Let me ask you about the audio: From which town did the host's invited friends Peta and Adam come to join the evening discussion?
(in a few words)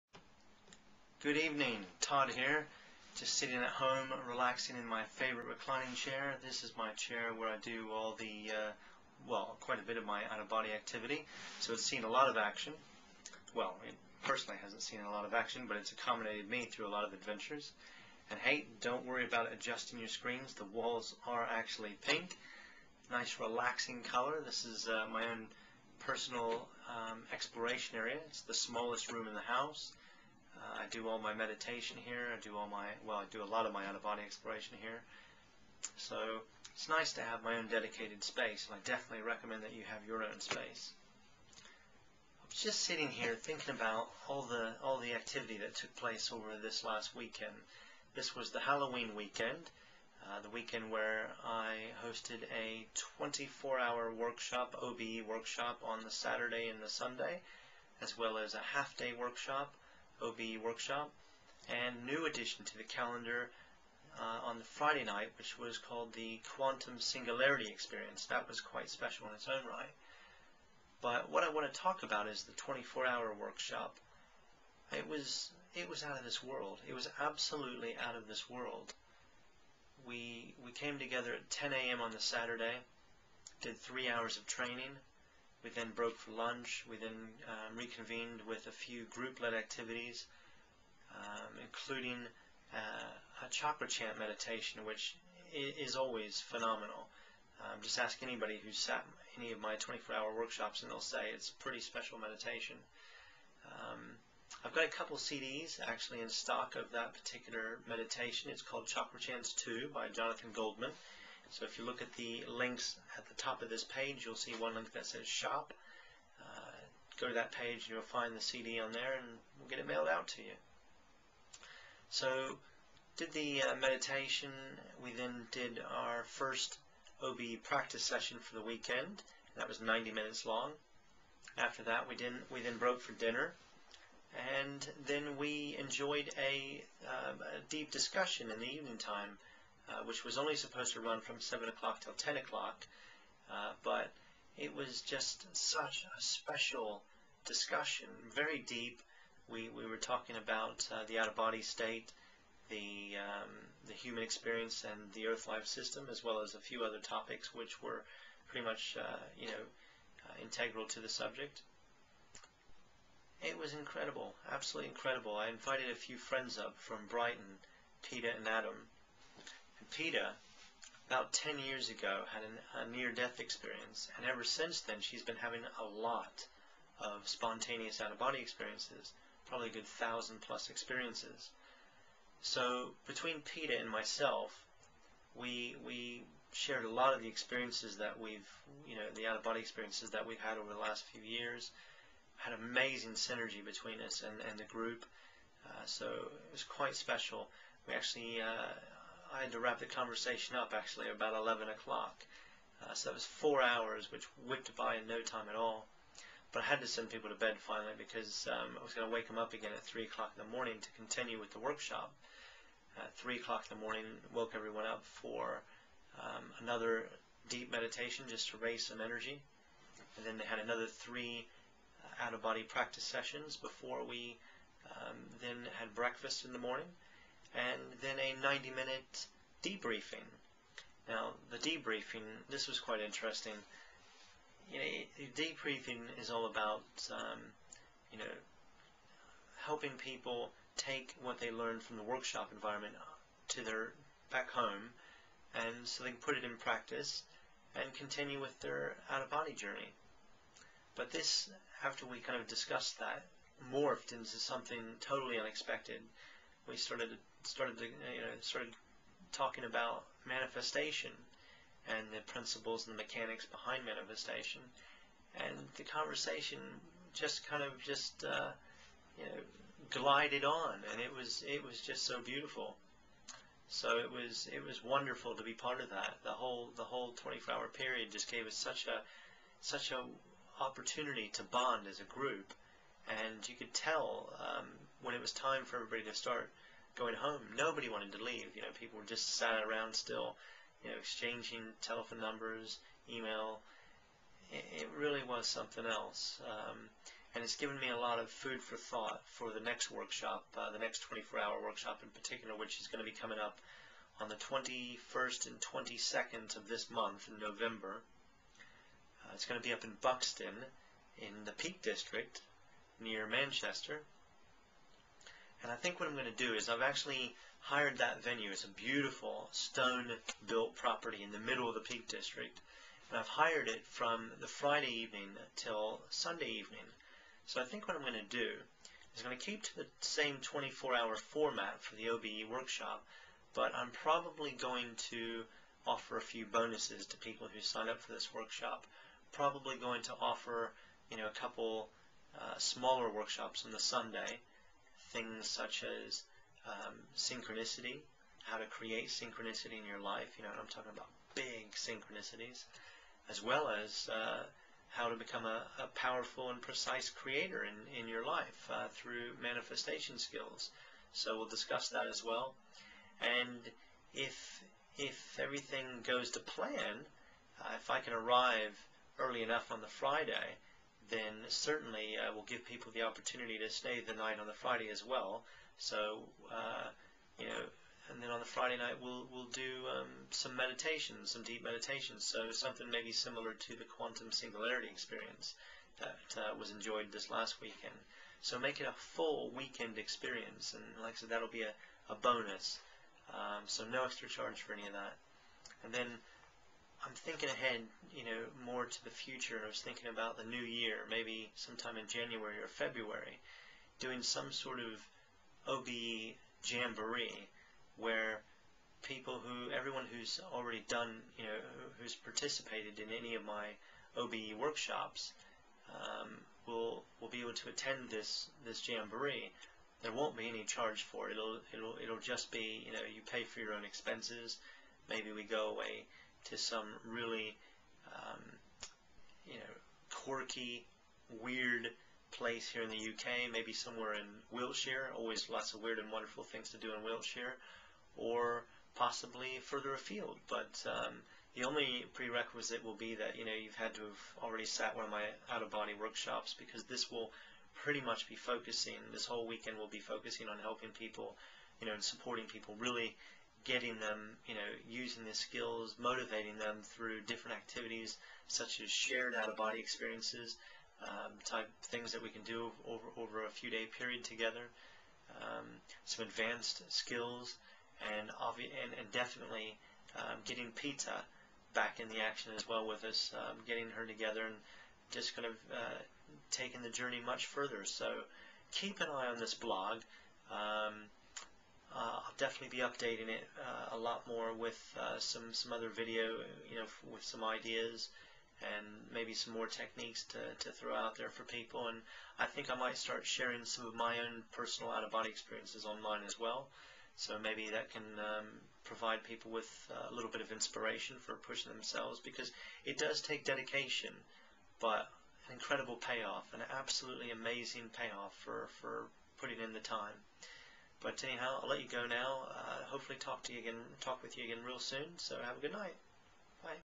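Brighton.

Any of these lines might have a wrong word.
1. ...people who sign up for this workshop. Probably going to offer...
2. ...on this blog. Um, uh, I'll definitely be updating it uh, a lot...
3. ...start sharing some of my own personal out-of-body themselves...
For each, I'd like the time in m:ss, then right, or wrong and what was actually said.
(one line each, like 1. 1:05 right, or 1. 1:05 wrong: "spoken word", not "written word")
1. 5:37 right
2. 7:59 right
3. 8:12 wrong: "experiences", not "themselves".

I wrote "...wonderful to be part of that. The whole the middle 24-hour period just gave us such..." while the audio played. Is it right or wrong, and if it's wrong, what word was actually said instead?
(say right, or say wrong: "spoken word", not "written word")
wrong: "whole", not "middle".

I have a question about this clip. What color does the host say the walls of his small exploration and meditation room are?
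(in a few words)
Pink.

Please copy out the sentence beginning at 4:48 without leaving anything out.
You know, people were just sat around still, you know, exchanging telephone numbers, email.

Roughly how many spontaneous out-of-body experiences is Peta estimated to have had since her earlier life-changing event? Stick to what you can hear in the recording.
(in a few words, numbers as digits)
1,000 plus.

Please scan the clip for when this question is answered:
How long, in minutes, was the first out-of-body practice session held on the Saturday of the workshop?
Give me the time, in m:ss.
2:09.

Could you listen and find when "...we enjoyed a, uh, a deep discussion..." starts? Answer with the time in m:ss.
2:15.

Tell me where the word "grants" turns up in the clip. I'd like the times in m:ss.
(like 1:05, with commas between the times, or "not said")
not said.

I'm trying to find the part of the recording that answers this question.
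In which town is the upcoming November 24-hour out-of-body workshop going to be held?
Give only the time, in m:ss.
5:10.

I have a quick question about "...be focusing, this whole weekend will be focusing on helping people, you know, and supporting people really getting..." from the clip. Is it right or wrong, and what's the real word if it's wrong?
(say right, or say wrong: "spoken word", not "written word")
right.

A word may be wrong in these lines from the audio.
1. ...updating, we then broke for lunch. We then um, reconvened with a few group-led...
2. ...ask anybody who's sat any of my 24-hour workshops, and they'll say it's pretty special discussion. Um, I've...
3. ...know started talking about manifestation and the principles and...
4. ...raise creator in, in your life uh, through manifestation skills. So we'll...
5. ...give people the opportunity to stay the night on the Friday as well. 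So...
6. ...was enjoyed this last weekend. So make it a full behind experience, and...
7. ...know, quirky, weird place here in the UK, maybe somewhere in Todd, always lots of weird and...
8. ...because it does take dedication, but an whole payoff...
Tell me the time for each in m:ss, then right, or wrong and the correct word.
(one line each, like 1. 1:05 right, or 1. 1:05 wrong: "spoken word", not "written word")
1. 1:24 wrong: "training", not "updating"
2. 1:37 wrong: "meditation", not "discussion"
3. 4:18 right
4. 5:56 wrong: "precise", not "raise"
5. 6:12 right
6. 6:26 wrong: "weekend", not "behind"
7. 7:09 wrong: "Wiltshire", not "Todd"
8. 8:22 wrong: "incredible", not "whole".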